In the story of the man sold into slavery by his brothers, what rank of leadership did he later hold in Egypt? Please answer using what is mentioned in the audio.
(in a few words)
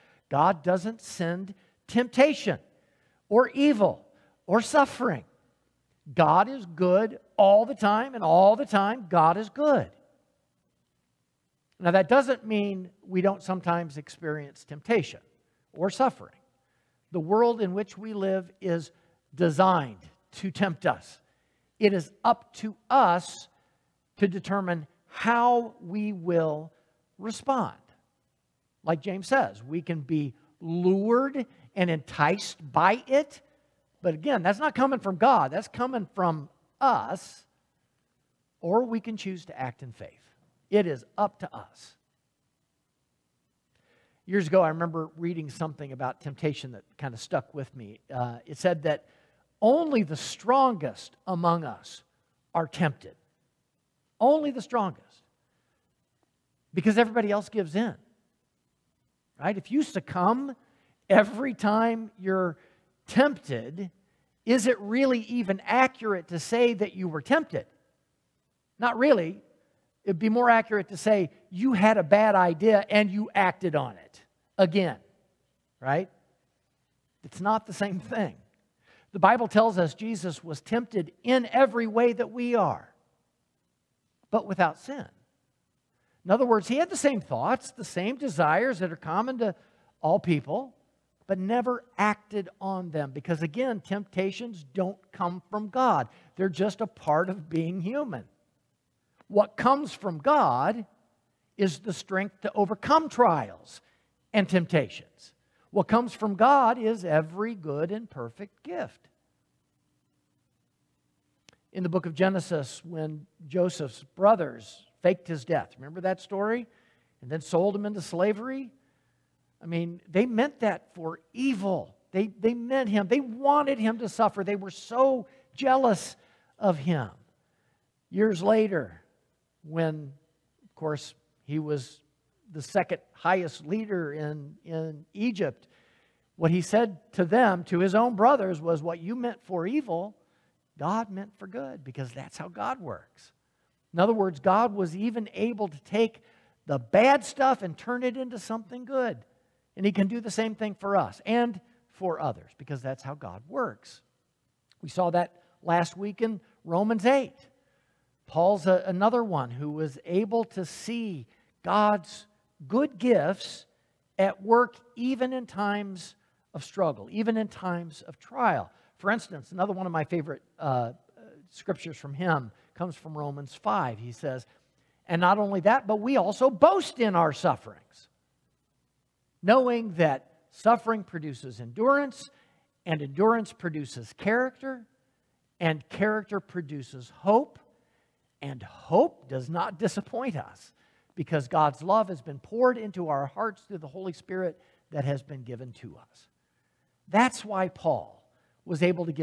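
Second highest.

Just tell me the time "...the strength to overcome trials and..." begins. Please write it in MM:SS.
01:41.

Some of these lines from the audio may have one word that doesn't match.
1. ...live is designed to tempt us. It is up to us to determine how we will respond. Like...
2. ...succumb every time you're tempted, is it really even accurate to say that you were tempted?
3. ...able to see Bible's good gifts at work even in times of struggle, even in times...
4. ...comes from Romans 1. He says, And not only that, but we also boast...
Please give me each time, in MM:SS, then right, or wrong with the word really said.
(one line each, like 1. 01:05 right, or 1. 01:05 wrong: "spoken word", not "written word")
1. 00:18 right
2. 00:59 right
3. 02:40 wrong: "God", not "Bible"
4. 02:52 wrong: "5", not "1".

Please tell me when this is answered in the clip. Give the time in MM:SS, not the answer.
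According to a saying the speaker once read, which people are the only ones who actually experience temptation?
00:49.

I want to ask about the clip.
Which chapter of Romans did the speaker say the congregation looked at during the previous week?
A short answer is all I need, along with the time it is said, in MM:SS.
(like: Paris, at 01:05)
Romans 8, at 02:36.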